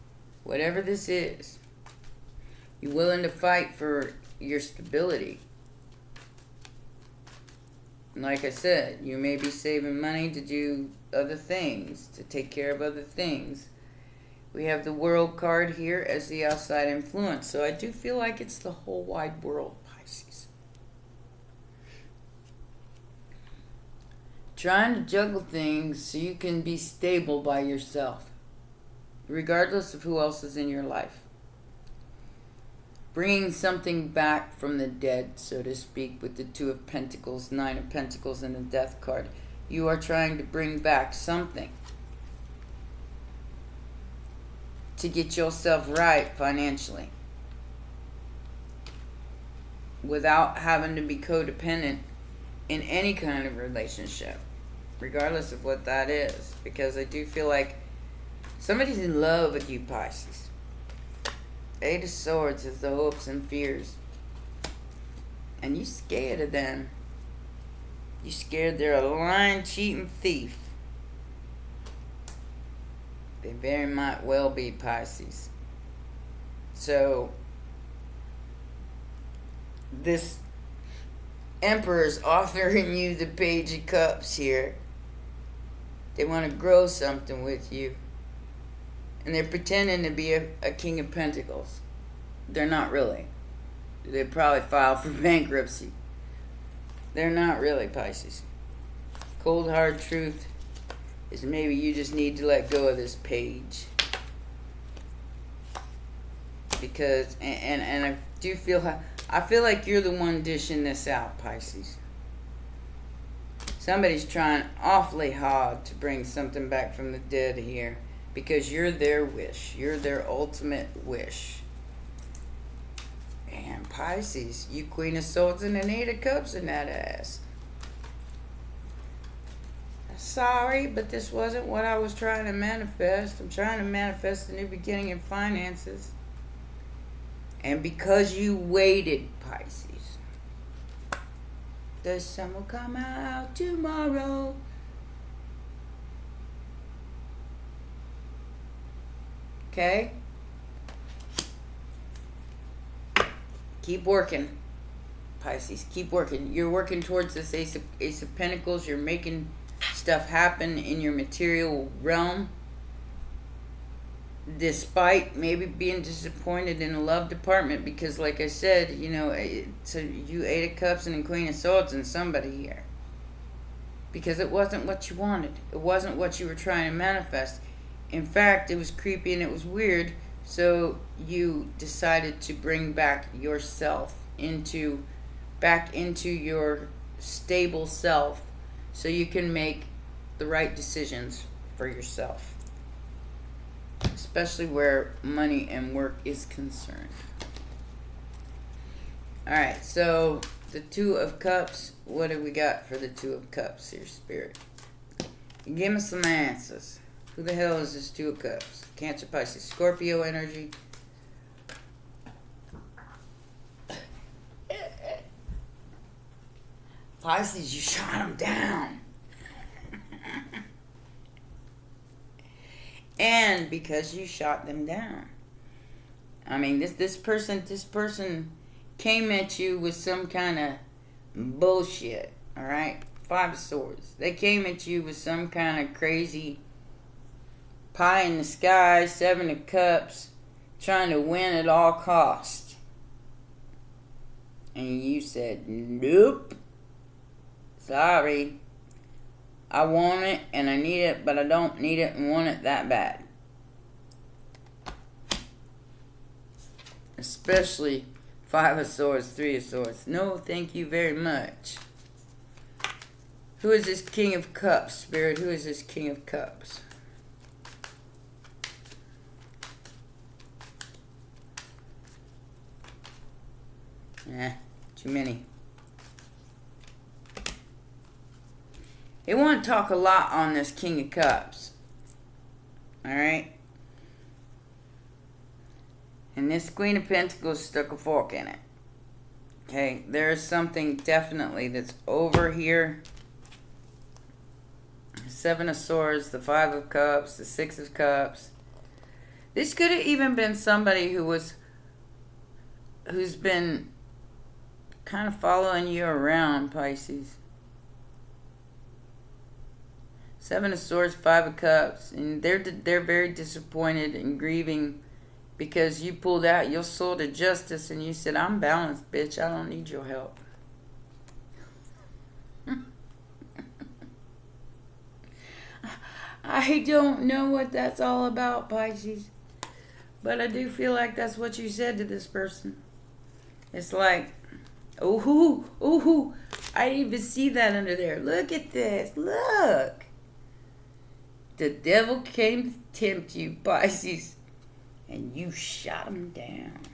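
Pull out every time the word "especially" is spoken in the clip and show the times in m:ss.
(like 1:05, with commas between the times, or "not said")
3:14, 4:17.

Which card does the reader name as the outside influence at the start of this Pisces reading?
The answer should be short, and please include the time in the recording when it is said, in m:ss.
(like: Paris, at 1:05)
The World, at 0:14.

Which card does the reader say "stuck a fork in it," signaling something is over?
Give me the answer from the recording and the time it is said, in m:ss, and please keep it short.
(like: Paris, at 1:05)
Queen of Pentacles, at 4:46.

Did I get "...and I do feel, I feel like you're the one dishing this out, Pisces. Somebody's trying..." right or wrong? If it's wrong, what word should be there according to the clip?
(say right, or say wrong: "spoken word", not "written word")
right.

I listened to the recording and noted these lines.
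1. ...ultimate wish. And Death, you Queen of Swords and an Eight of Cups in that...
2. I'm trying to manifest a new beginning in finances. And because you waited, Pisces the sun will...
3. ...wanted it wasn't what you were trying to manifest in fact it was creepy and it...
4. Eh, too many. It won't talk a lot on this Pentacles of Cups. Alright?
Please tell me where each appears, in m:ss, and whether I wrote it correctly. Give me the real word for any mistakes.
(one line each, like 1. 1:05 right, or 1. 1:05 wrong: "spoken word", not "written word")
1. 2:00 wrong: "Pisces", not "Death"
2. 2:13 right
3. 2:55 right
4. 4:34 wrong: "King", not "Pentacles".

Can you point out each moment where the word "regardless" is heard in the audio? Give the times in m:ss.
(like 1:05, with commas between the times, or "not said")
0:29, 0:55.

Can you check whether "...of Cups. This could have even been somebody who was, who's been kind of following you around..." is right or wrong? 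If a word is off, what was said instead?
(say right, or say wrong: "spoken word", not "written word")
right.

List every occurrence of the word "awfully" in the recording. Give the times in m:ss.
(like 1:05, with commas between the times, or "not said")
1:54.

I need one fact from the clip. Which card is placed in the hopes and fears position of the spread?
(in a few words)
Eight of Swords.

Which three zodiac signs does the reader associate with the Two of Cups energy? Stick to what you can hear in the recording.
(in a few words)
Cancer, Pisces, Scorpio.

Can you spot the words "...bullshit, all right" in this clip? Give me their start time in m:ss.
3:51.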